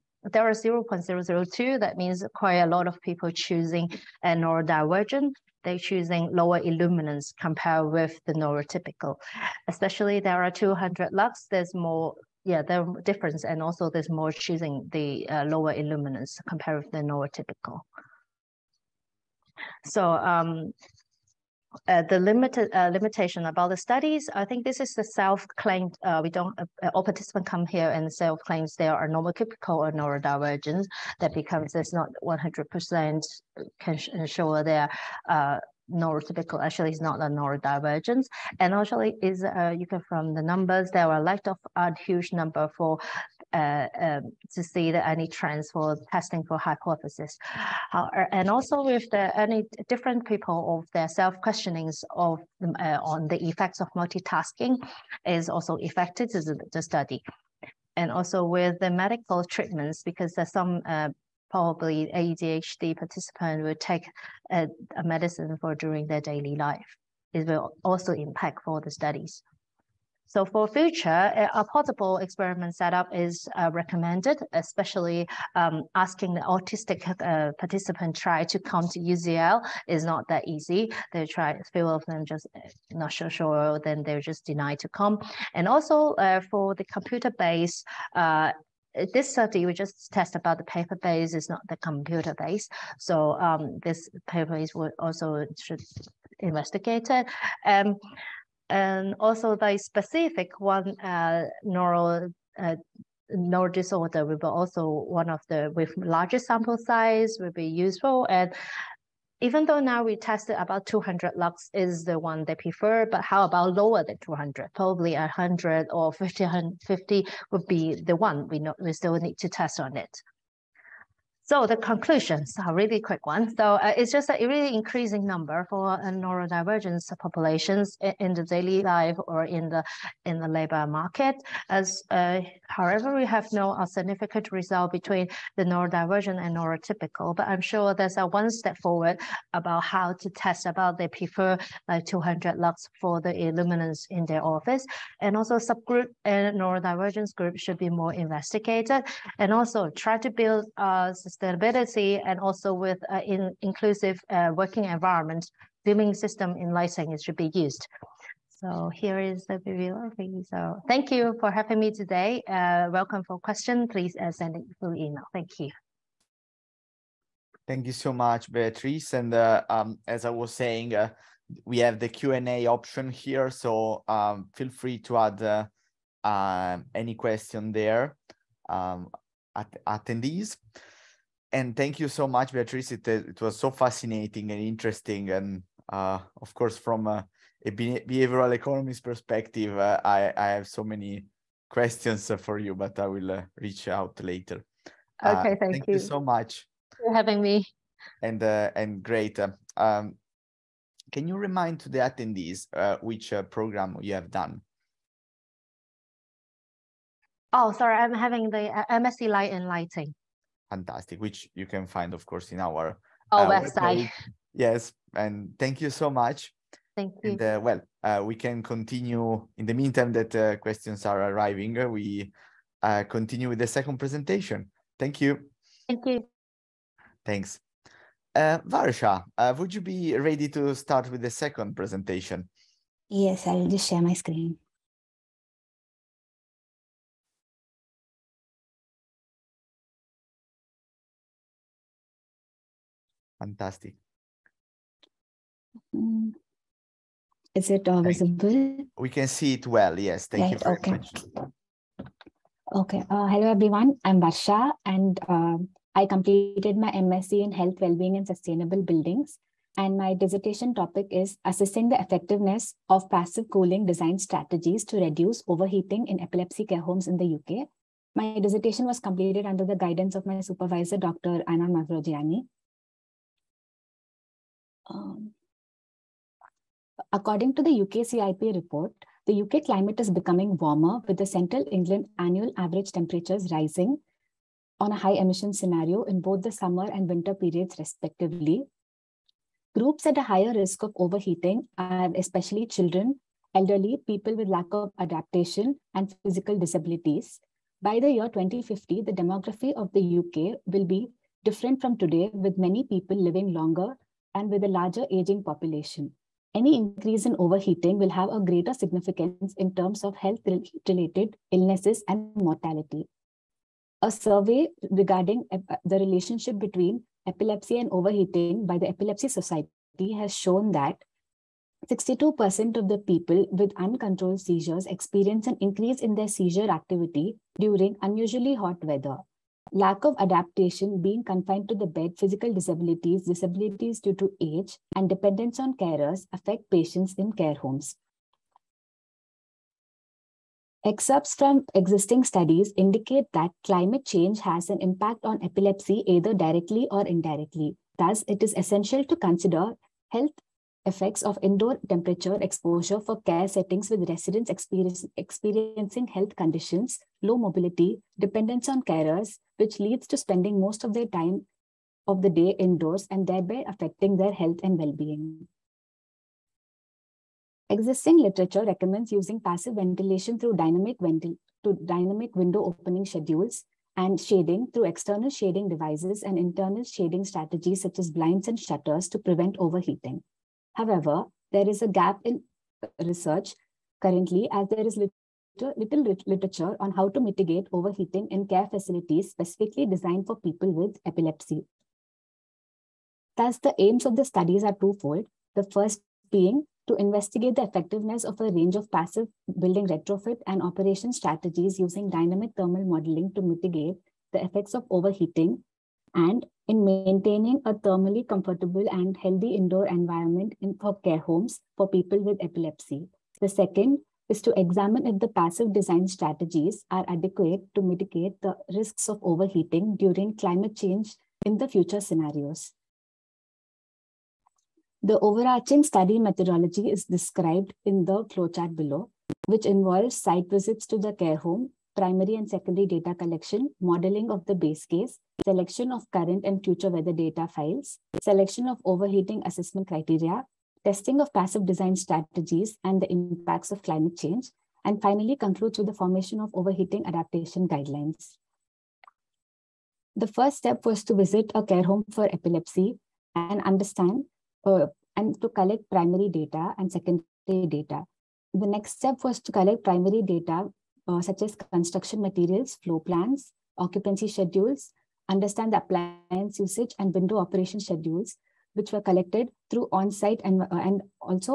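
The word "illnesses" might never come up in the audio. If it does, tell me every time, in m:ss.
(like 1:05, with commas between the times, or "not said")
5:11.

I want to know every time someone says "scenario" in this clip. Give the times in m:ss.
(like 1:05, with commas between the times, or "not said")
4:45, 7:02.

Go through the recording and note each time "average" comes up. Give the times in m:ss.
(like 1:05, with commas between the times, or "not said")
4:42.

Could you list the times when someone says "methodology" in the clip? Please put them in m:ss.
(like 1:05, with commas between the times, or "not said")
7:06.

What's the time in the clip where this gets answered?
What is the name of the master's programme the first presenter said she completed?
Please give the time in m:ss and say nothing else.
3:28.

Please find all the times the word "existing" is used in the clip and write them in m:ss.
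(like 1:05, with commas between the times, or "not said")
5:41, 6:07.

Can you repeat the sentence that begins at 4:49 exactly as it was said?
Groups at a higher risk of overheating are especially children, elderly, people with lack of adaptation, and physical disabilities.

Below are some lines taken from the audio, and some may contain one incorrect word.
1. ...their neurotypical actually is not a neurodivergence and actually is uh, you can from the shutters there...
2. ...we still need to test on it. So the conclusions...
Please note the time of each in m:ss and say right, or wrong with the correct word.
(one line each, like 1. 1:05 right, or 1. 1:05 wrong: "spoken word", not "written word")
1. 0:35 wrong: "numbers", not "shutters"
2. 1:58 right.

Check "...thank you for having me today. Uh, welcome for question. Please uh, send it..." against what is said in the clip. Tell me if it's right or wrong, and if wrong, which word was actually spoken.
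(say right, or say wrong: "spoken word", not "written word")
right.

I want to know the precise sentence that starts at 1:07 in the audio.
It will also impact for the studies.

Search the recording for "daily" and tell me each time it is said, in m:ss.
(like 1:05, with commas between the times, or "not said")
1:06, 2:08.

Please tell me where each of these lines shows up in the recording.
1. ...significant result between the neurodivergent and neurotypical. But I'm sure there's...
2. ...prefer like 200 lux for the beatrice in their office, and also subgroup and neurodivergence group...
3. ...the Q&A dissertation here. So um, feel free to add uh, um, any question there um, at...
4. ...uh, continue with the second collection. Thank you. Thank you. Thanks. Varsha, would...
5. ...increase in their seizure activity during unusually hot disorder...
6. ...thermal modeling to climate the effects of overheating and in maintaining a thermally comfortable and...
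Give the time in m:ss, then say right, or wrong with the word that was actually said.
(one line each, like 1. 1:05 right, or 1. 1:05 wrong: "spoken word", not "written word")
1. 2:13 right
2. 2:21 wrong: "illuminance", not "beatrice"
3. 2:51 wrong: "option", not "dissertation"
4. 3:42 wrong: "presentation", not "collection"
5. 5:25 wrong: "weather", not "disorder"
6. 6:42 wrong: "mitigate", not "climate".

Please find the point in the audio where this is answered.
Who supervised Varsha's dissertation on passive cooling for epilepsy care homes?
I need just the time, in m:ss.
4:30.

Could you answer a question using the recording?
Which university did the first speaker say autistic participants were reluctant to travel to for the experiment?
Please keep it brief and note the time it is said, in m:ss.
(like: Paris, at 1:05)
UCL, at 1:18.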